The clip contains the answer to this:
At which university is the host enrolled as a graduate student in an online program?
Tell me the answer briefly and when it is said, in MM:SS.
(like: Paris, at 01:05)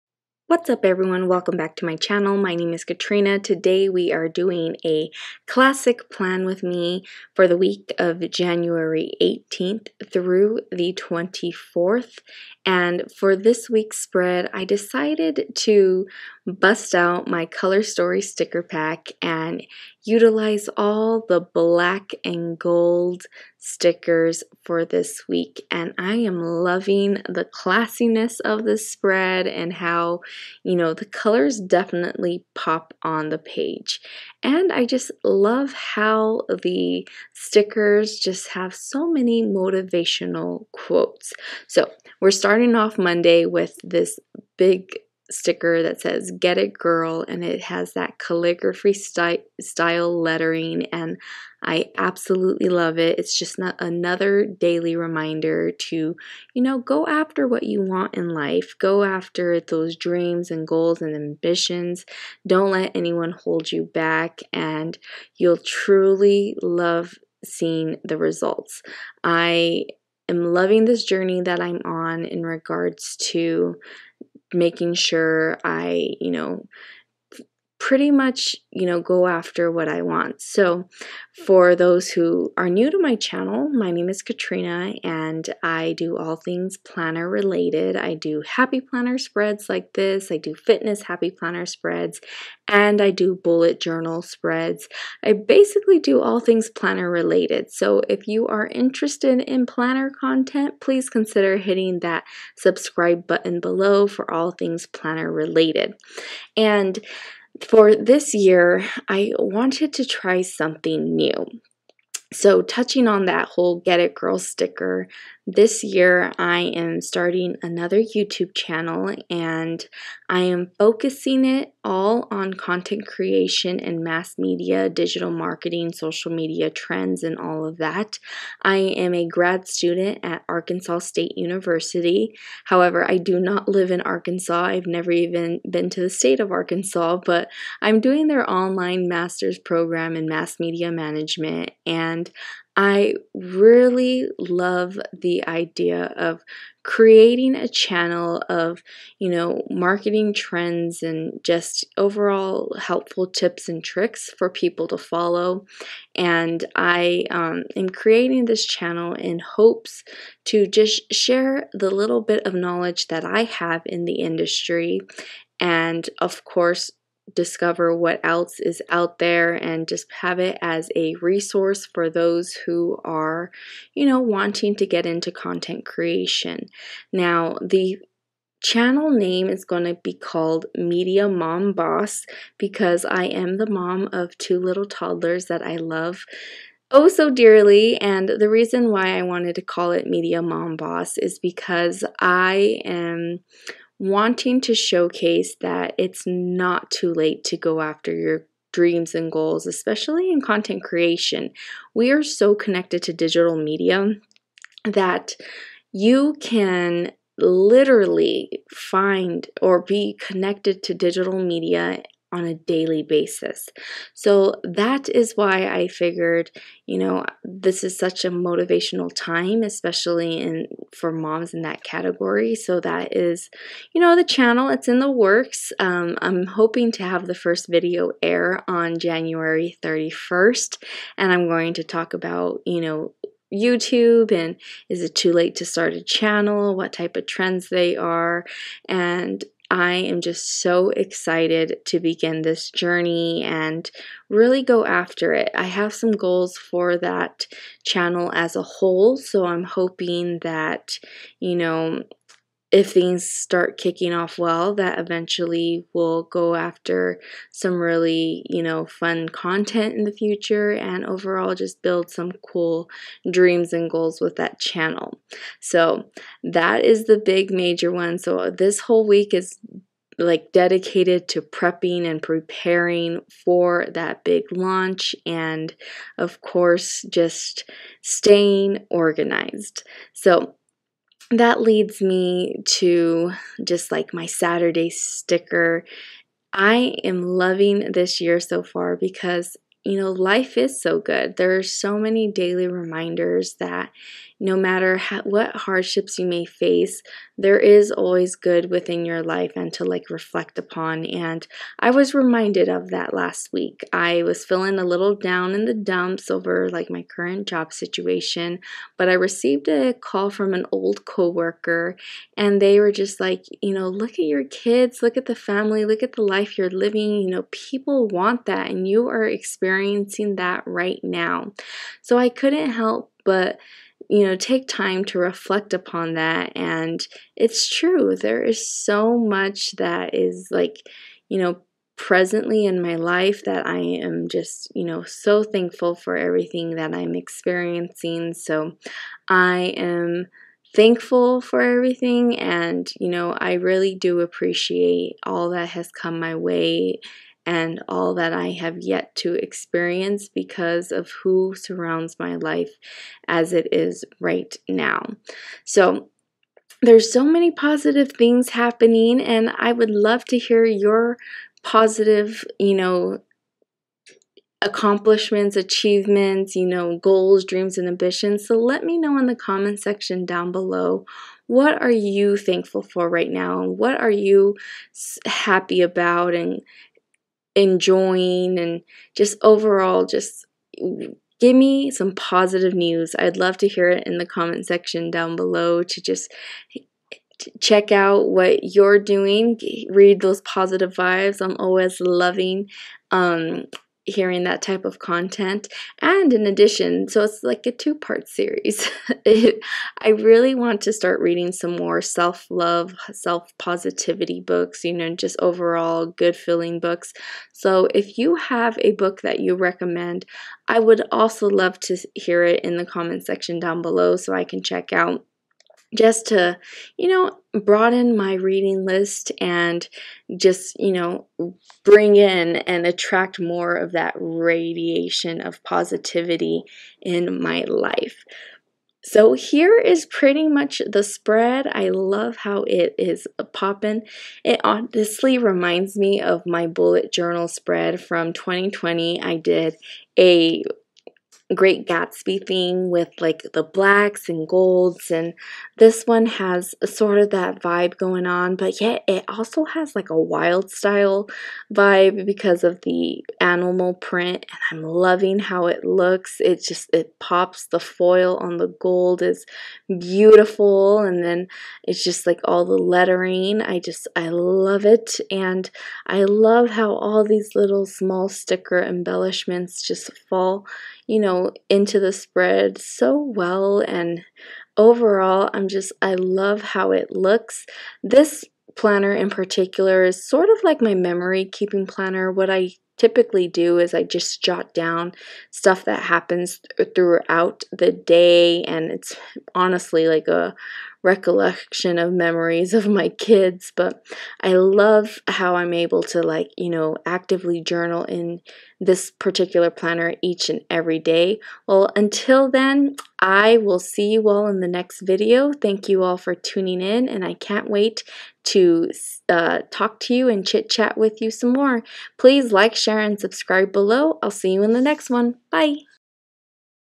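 Arkansas State University, at 02:10.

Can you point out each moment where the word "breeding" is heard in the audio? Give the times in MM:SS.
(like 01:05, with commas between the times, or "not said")
not said.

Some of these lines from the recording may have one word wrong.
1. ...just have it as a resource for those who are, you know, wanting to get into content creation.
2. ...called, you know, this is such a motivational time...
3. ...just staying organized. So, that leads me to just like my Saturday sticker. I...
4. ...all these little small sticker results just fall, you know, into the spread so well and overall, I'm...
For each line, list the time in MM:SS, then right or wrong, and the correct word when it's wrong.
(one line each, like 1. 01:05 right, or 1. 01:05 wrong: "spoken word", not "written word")
1. 02:49 right
2. 03:35 wrong: "figured", not "called"
3. 04:37 right
4. 07:46 wrong: "embellishments", not "results".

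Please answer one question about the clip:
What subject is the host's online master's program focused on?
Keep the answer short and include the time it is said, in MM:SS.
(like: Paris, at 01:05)
Mass media management, at 02:20.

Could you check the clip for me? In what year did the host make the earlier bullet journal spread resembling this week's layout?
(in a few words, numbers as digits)
2020.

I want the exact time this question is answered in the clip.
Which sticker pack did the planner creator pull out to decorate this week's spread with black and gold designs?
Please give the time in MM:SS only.
00:17.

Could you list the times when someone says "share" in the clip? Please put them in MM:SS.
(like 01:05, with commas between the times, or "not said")
02:41, 08:32.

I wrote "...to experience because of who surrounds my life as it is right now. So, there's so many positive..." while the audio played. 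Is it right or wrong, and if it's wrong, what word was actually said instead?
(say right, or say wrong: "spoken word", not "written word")
right.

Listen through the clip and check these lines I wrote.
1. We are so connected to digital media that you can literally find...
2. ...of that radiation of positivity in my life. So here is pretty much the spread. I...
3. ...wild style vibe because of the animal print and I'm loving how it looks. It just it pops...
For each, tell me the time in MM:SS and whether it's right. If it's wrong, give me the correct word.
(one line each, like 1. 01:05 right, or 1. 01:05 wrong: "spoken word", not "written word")
1. 03:21 right
2. 07:03 right
3. 07:30 right.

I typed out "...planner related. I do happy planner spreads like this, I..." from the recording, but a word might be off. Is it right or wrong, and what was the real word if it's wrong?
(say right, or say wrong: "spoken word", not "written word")
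right.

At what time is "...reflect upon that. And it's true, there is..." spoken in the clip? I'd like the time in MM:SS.
05:25.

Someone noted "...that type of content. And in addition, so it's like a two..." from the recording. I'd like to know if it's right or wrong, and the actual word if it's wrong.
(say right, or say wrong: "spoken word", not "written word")
right.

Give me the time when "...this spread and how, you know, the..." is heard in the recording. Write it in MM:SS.
00:28.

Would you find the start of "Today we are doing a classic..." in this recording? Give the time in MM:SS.
00:03.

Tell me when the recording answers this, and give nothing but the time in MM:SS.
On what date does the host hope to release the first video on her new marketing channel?
03:48.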